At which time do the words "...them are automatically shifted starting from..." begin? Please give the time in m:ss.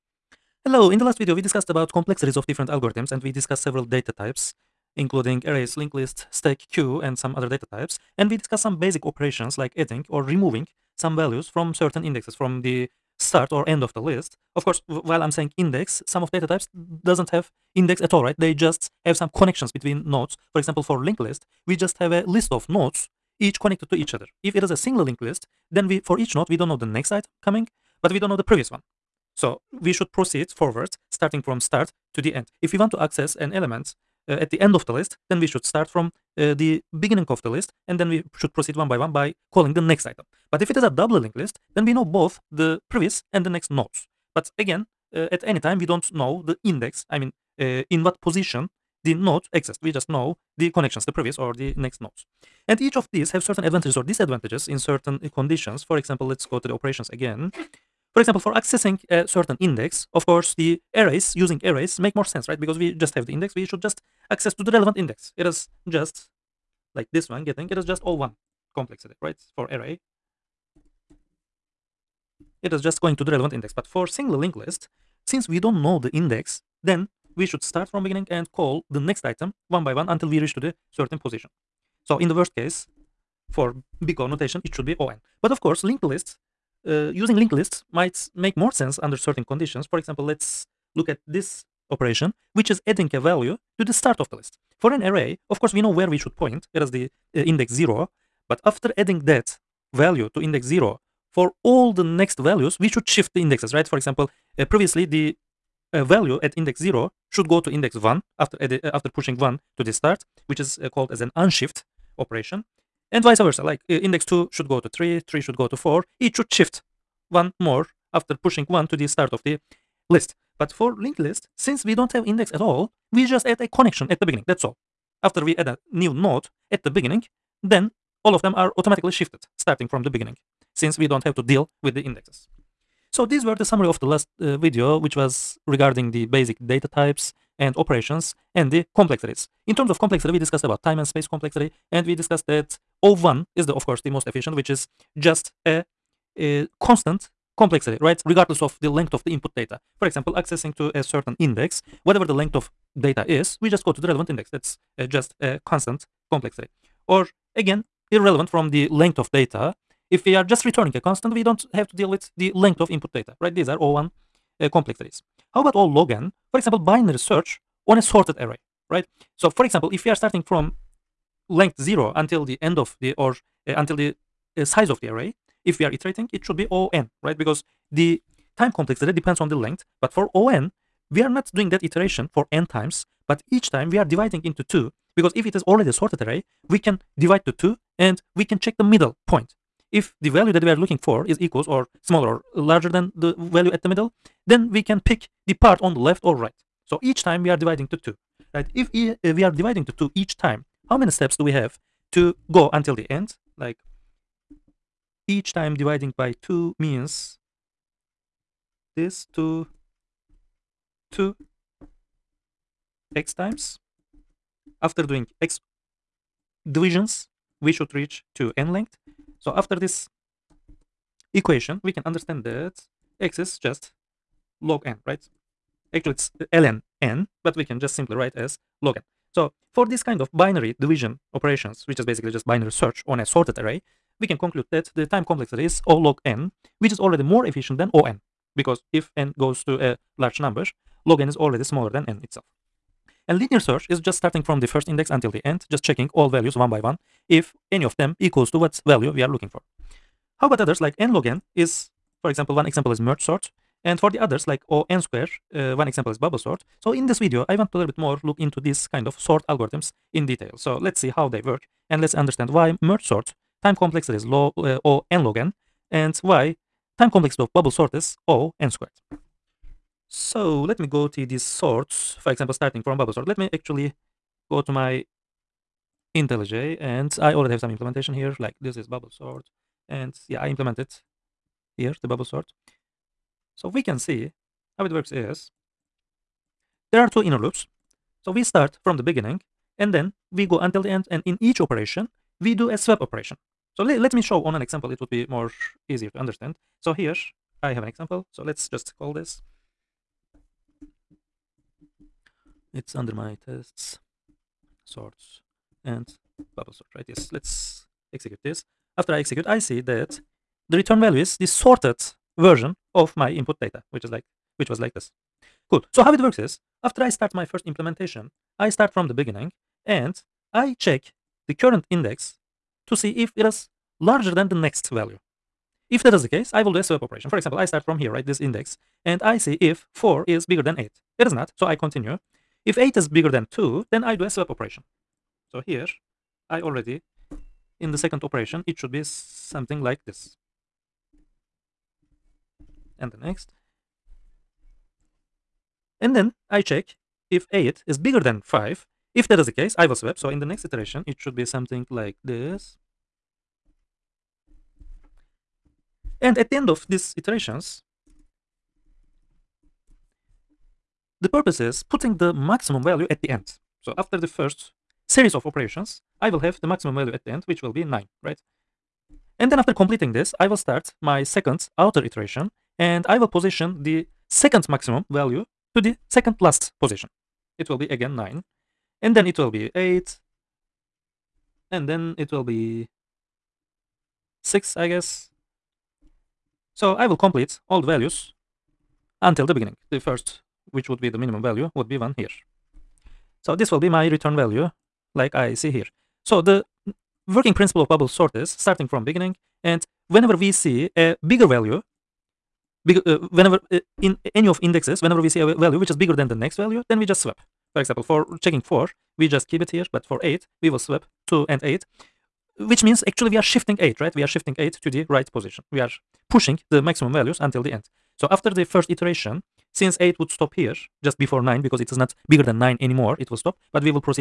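2:08.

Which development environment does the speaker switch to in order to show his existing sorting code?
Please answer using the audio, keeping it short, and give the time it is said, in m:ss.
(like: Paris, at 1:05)
IntelliJ, at 4:36.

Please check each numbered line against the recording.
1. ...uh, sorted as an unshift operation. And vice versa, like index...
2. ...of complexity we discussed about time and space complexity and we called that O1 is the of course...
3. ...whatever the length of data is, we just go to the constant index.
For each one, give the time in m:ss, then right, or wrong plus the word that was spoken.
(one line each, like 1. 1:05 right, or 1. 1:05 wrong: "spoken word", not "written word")
1. 1:50 wrong: "called", not "sorted"
2. 2:19 wrong: "discussed", not "called"
3. 2:32 wrong: "relevant", not "constant".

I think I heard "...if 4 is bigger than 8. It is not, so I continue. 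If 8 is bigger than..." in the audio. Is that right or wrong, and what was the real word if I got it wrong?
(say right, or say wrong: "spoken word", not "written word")
right.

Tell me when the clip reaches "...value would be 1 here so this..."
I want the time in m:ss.
6:31.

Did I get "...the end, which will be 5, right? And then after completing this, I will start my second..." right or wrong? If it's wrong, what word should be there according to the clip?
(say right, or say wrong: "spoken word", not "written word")
wrong: "9", not "5".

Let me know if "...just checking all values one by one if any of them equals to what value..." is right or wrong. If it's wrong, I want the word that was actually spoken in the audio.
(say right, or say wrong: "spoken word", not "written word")
right.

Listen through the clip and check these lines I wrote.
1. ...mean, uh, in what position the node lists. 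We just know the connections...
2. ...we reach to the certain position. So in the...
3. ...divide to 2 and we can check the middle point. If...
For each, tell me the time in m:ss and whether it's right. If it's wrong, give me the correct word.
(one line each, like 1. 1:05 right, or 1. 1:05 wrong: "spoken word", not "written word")
1. 0:47 wrong: "exists", not "lists"
2. 1:20 right
3. 3:07 right.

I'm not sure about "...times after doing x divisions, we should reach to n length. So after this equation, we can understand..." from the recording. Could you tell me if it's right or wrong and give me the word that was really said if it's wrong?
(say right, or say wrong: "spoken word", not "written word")
right.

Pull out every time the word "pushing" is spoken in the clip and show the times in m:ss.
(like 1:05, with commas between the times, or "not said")
1:49, 1:58, 6:56.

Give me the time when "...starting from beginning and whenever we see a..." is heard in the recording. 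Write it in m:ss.
6:38.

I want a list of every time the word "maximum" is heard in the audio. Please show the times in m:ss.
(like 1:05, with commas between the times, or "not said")
6:02, 6:06, 6:14, 6:56.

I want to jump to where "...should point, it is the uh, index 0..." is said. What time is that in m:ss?
1:36.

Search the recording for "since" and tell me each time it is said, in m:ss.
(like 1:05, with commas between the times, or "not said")
1:15, 2:01, 2:10, 6:59.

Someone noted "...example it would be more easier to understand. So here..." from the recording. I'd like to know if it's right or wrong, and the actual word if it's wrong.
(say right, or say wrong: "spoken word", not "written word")
right.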